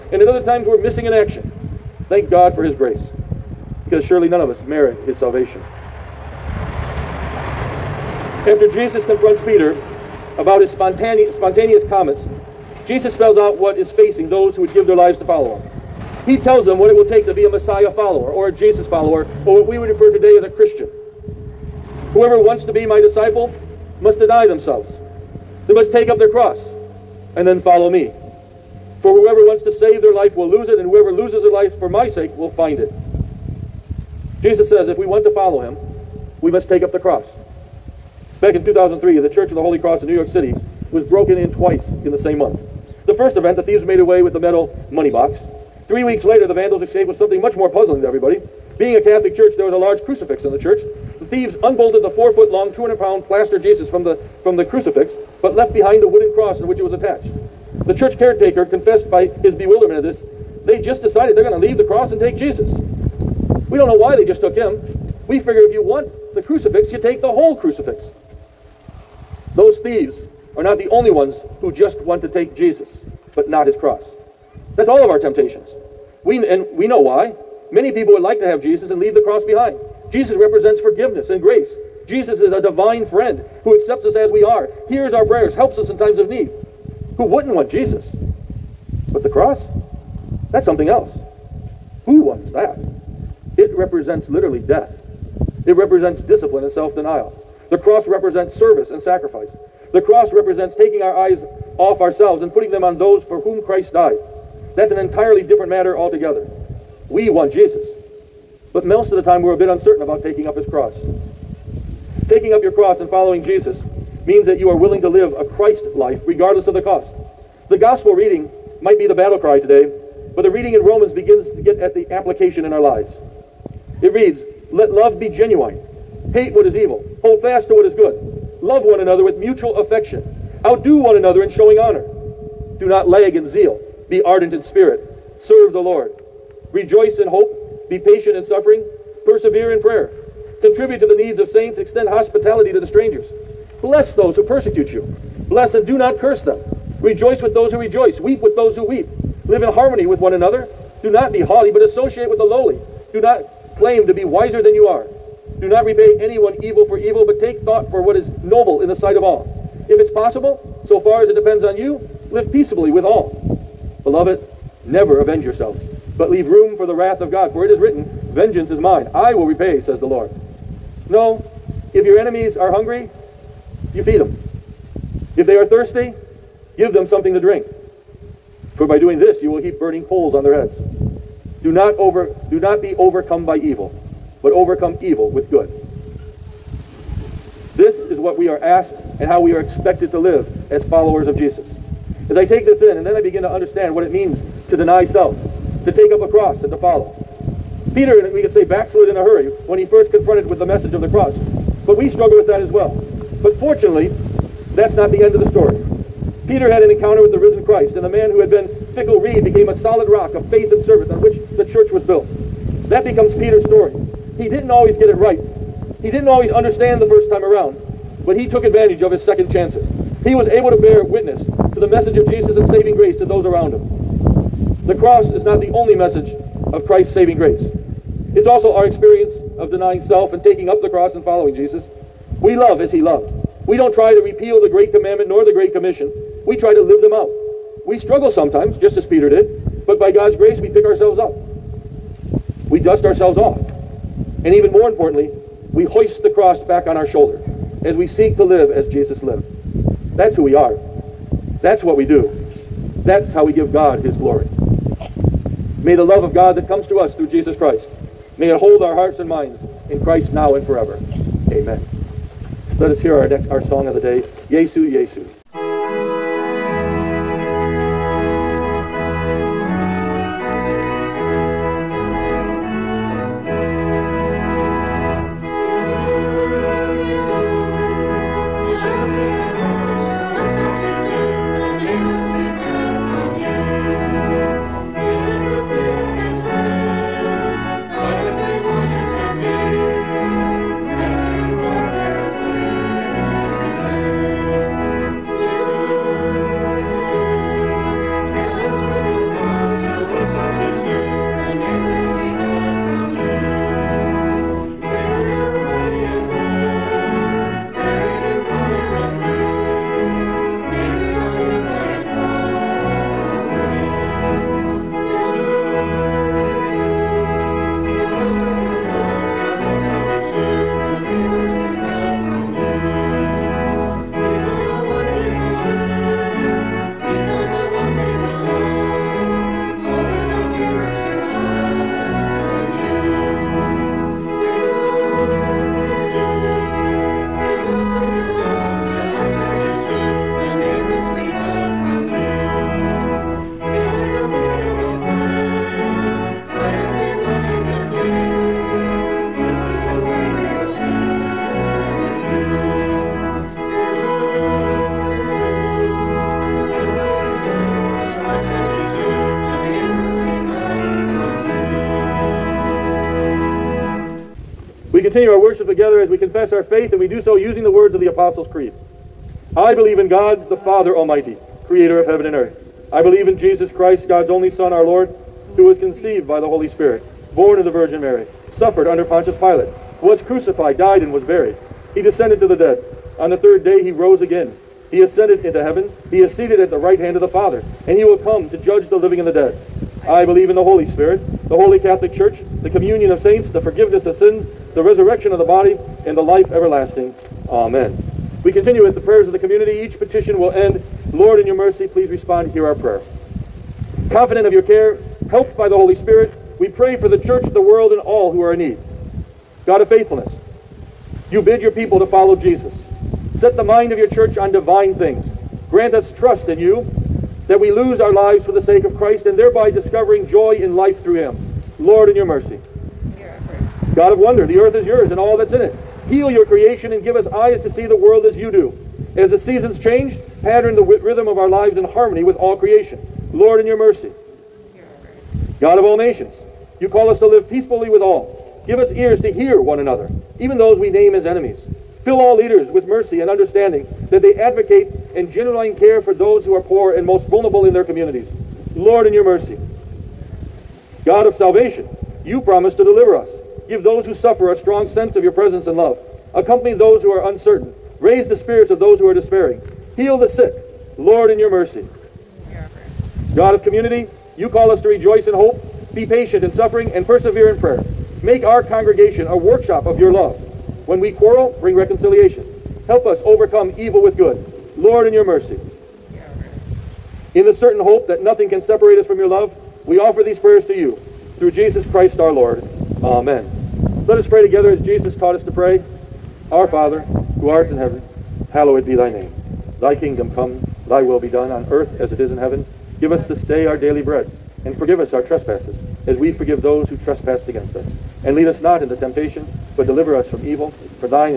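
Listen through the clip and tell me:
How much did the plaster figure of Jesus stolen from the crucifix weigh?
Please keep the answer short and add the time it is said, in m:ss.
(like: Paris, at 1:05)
200 pounds, at 0:52.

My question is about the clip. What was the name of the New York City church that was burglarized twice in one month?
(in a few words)
Church of the Holy Cross.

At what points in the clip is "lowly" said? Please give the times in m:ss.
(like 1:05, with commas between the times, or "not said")
2:32.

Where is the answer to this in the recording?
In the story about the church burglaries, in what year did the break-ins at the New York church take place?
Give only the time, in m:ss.
0:38.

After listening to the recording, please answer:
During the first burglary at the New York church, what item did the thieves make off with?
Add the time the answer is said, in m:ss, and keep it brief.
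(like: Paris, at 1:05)
metal money box, at 0:44.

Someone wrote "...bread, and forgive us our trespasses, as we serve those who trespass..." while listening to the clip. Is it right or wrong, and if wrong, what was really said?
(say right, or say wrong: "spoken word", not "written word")
wrong: "forgive", not "serve".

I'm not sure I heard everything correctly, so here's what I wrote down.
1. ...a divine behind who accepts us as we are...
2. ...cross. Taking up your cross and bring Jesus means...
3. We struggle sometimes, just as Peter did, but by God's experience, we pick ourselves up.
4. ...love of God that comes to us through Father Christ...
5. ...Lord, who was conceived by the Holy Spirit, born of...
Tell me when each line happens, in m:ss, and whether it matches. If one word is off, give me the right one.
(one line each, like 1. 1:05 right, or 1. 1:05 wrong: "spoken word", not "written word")
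1. 1:22 wrong: "friend", not "behind"
2. 1:50 wrong: "following", not "bring"
3. 3:57 wrong: "grace", not "experience"
4. 4:16 wrong: "Jesus", not "Father"
5. 6:14 right.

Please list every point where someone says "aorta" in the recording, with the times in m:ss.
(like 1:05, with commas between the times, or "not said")
not said.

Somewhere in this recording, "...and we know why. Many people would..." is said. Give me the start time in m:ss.
1:16.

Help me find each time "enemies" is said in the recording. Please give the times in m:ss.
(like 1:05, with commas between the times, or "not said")
2:52, 7:21.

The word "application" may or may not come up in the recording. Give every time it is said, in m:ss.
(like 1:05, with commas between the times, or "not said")
2:02.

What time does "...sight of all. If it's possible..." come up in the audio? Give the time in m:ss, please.
2:38.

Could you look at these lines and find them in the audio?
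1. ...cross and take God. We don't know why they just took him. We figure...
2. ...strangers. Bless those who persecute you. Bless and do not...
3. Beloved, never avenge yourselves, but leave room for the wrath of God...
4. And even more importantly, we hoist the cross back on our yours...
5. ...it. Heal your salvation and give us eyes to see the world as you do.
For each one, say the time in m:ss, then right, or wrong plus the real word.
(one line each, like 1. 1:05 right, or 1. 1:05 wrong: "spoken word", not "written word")
1. 1:01 wrong: "Jesus", not "God"
2. 2:22 right
3. 2:44 right
4. 4:04 wrong: "shoulders", not "yours"
5. 7:05 wrong: "creation", not "salvation".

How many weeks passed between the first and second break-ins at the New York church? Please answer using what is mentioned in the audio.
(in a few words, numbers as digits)
3.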